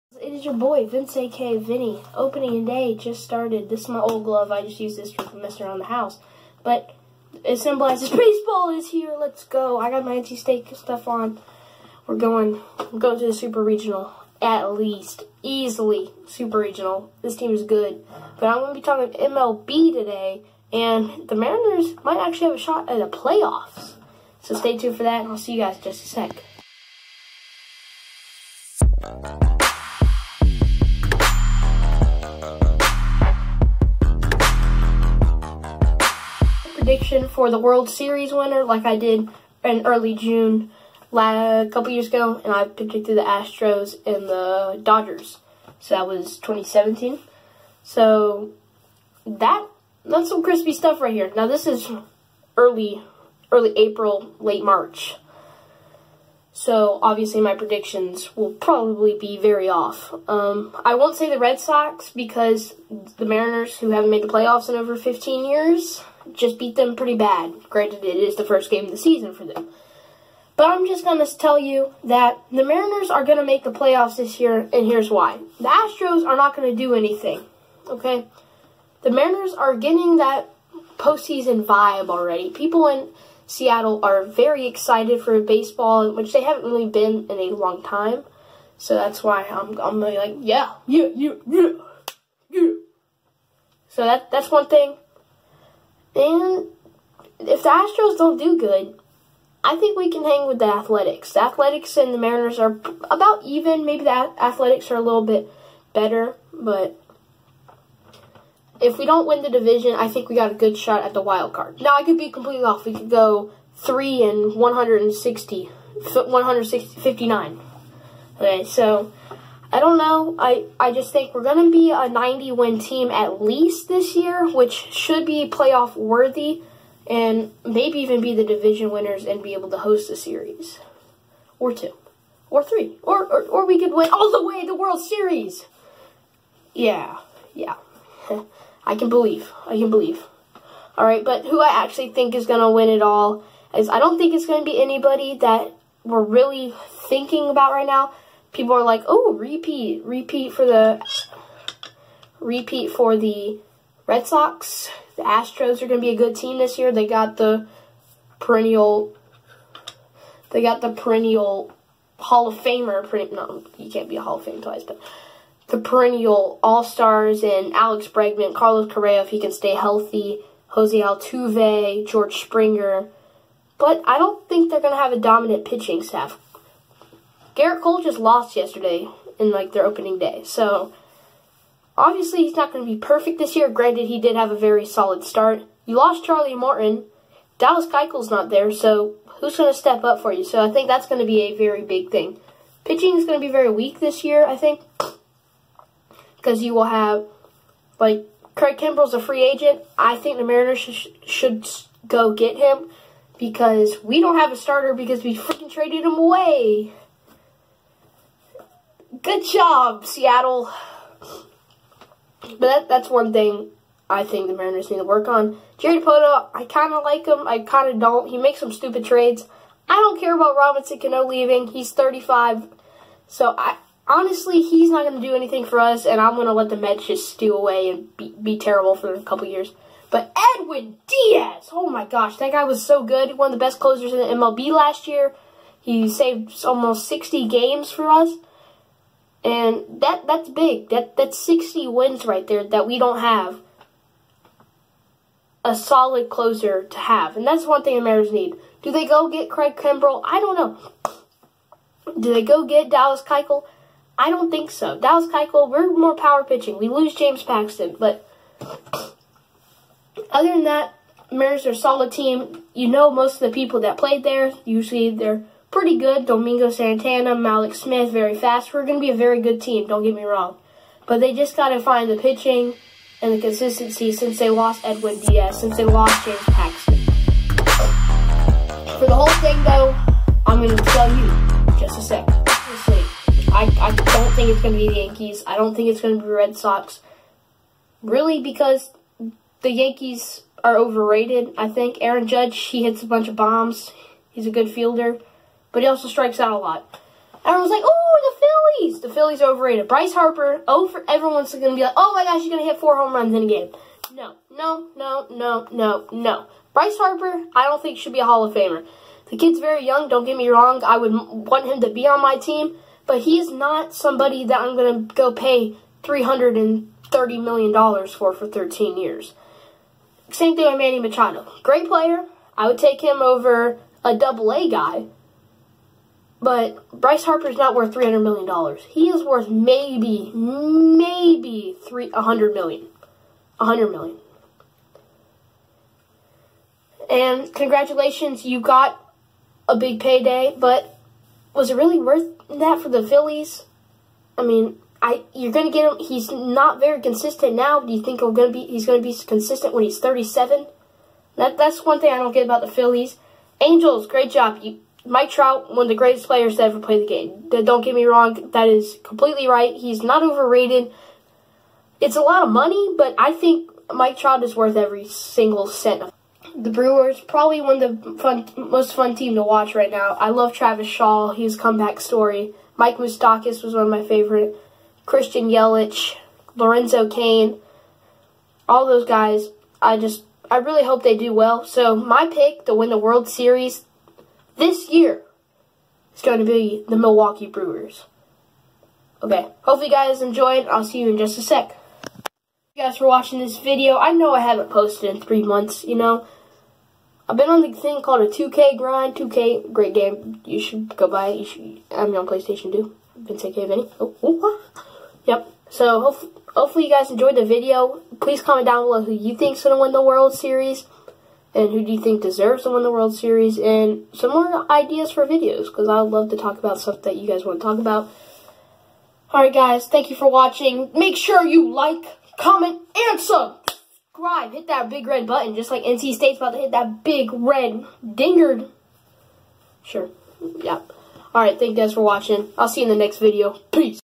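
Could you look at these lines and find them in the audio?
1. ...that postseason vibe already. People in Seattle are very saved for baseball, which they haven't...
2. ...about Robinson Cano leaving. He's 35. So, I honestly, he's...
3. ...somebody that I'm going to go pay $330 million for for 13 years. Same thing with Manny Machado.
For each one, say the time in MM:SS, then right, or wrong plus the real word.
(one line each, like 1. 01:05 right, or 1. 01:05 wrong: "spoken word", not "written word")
1. 01:20 wrong: "excited", not "saved"
2. 03:40 right
3. 05:13 right.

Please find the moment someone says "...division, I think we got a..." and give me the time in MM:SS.
01:49.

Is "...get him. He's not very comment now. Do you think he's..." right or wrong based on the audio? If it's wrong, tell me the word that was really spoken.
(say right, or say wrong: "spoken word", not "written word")
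wrong: "consistent", not "comment".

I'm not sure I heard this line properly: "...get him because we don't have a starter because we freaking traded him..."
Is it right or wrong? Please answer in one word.
right.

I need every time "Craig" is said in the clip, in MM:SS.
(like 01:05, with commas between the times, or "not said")
03:18, 04:09.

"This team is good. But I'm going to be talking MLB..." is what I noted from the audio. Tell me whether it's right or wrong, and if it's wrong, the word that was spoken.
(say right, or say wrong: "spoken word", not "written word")
right.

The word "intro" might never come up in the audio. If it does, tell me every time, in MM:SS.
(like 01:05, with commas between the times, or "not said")
not said.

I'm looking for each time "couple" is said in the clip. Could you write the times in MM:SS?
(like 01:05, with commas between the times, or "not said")
00:41, 03:49.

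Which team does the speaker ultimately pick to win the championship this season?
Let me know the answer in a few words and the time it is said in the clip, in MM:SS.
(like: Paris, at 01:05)
Milwaukee Brewers, at 06:26.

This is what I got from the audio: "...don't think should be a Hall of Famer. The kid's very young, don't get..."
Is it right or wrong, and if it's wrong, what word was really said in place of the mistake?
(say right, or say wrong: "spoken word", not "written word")
right.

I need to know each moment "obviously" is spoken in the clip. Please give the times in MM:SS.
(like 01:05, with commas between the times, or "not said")
00:57, 03:01.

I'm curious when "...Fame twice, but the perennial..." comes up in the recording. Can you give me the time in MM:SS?
02:44.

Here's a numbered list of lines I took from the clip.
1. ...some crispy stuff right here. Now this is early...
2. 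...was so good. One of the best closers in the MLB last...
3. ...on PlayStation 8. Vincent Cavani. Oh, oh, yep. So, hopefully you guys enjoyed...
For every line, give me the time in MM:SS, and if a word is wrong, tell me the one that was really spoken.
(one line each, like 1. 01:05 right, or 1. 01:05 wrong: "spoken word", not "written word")
1. 00:50 right
2. 03:52 right
3. 06:42 wrong: "2", not "8".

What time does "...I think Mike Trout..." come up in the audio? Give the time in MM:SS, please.
06:03.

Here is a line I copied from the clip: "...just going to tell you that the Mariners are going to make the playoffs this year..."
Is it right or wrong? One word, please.
right.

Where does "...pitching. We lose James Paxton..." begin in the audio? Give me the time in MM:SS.
04:16.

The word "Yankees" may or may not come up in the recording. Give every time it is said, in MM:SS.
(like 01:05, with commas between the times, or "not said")
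04:44, 04:49.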